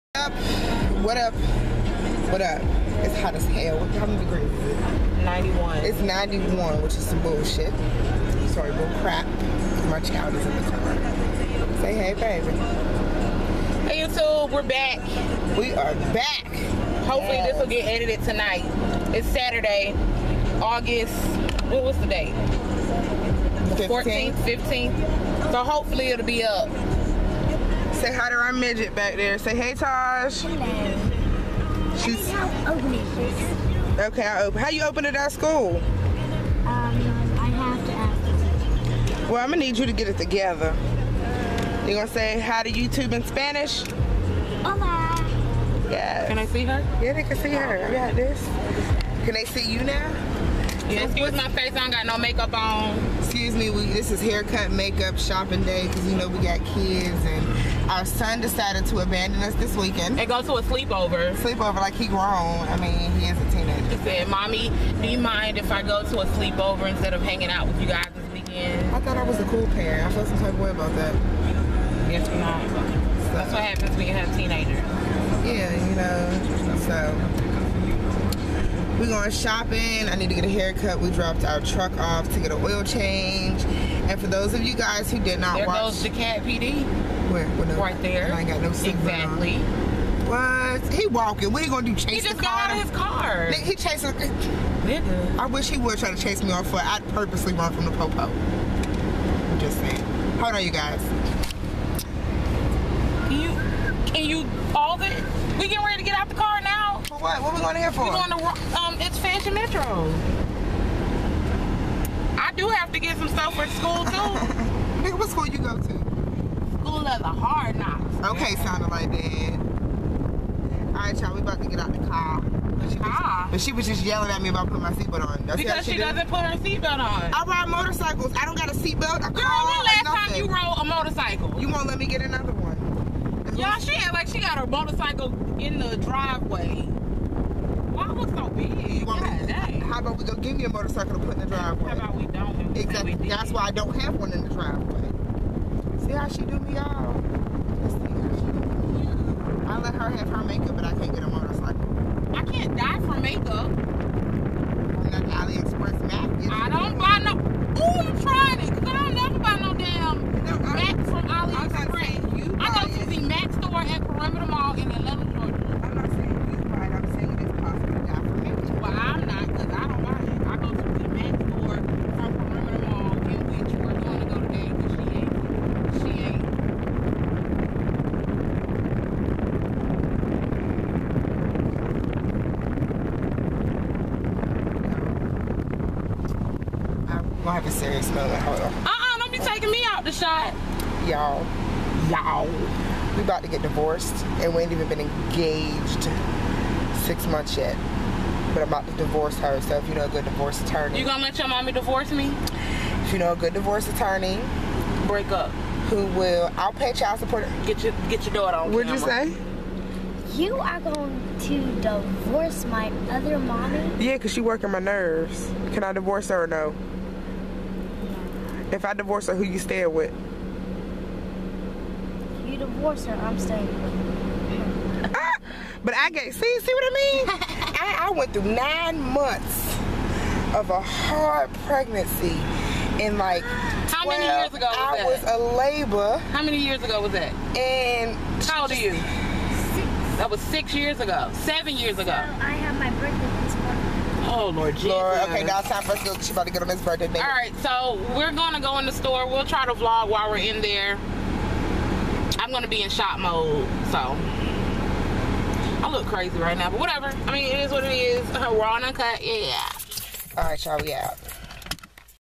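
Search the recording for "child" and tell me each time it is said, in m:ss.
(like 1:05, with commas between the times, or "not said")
0:09, 3:26.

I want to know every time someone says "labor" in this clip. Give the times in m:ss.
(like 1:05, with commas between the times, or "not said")
3:55.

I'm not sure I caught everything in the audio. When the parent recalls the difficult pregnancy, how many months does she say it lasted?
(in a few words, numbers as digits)
9.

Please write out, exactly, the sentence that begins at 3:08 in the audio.
Uh-uh, don't be taking me out the shot.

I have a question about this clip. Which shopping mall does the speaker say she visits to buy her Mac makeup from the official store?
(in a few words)
Perimeter Mall.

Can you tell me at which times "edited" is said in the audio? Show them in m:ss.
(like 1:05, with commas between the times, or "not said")
0:17.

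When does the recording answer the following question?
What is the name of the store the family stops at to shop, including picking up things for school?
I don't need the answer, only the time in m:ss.
1:49.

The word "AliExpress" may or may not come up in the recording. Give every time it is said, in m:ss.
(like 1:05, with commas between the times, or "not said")
2:35, 2:41.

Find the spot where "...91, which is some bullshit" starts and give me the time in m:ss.
0:05.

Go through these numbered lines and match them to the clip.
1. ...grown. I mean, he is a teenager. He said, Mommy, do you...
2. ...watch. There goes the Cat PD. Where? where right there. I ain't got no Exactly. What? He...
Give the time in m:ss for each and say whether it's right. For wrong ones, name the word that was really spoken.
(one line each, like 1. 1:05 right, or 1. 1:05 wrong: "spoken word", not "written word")
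1. 1:02 right
2. 1:25 right.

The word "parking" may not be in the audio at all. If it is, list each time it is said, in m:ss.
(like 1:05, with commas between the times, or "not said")
not said.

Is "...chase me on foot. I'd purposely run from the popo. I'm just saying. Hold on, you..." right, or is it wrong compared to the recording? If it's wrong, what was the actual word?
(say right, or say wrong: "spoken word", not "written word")
right.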